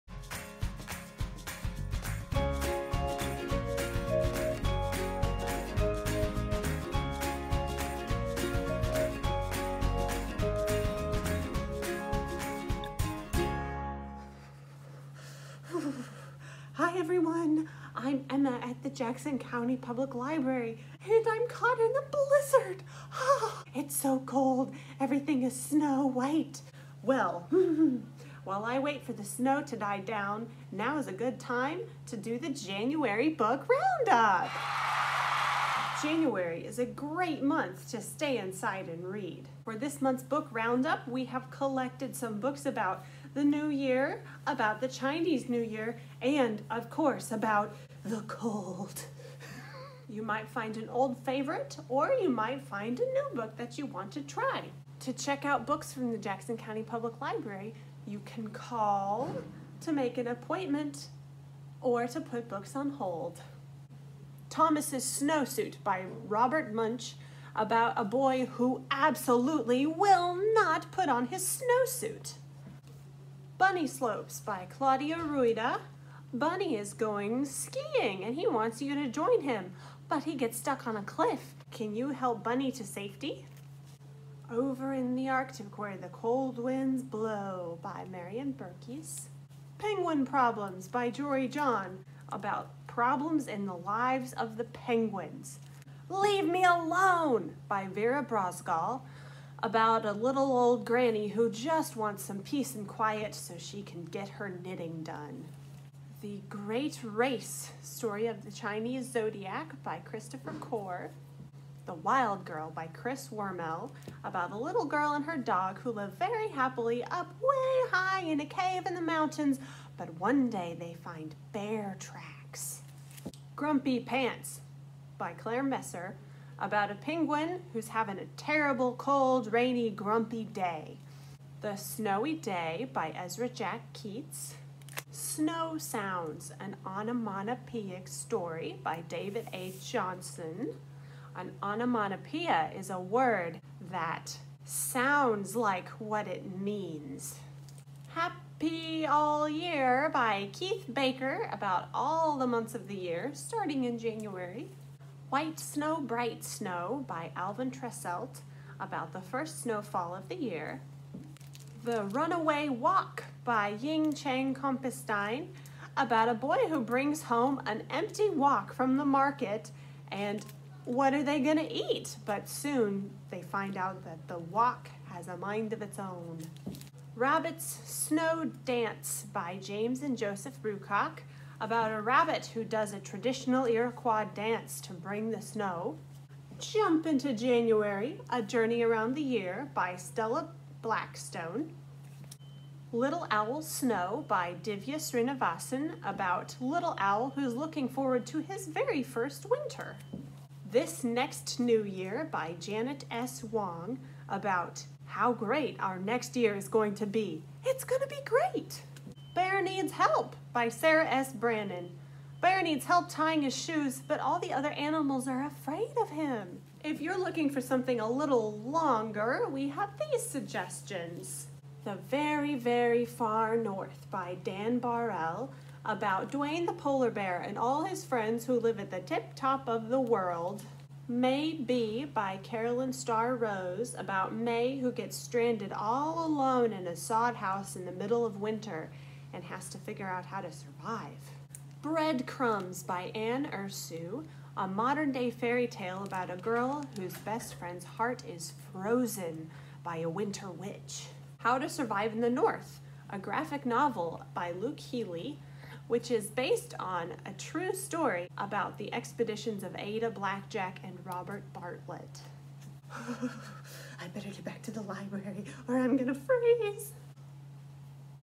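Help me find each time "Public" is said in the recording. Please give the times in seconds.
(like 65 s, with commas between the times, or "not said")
19 s, 56 s.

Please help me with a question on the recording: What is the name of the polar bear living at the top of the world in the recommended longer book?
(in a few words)
Duane.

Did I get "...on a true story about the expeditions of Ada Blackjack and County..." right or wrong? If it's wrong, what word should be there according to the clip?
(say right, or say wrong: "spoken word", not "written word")
wrong: "Robert", not "County".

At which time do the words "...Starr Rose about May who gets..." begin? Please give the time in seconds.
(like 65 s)
232 s.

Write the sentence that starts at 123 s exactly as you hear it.
Grumpy Pants by Claire Messer, about a penguin who's having a terrible, cold, rainy, grumpy day.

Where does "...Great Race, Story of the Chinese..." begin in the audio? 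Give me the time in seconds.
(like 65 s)
106 s.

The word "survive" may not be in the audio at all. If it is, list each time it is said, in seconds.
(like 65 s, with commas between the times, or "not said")
240 s, 251 s.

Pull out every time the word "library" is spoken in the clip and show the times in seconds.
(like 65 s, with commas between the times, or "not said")
20 s, 57 s, 264 s.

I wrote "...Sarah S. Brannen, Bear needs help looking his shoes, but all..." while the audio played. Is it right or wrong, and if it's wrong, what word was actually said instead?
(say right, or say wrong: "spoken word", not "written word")
wrong: "tying", not "looking".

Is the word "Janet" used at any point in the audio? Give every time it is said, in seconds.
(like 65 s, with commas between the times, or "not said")
202 s.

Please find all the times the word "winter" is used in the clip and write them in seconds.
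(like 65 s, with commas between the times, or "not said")
199 s, 238 s, 250 s.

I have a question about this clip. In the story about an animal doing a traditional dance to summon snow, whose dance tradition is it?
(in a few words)
Iroquois.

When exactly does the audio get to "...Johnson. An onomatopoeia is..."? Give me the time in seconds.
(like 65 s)
139 s.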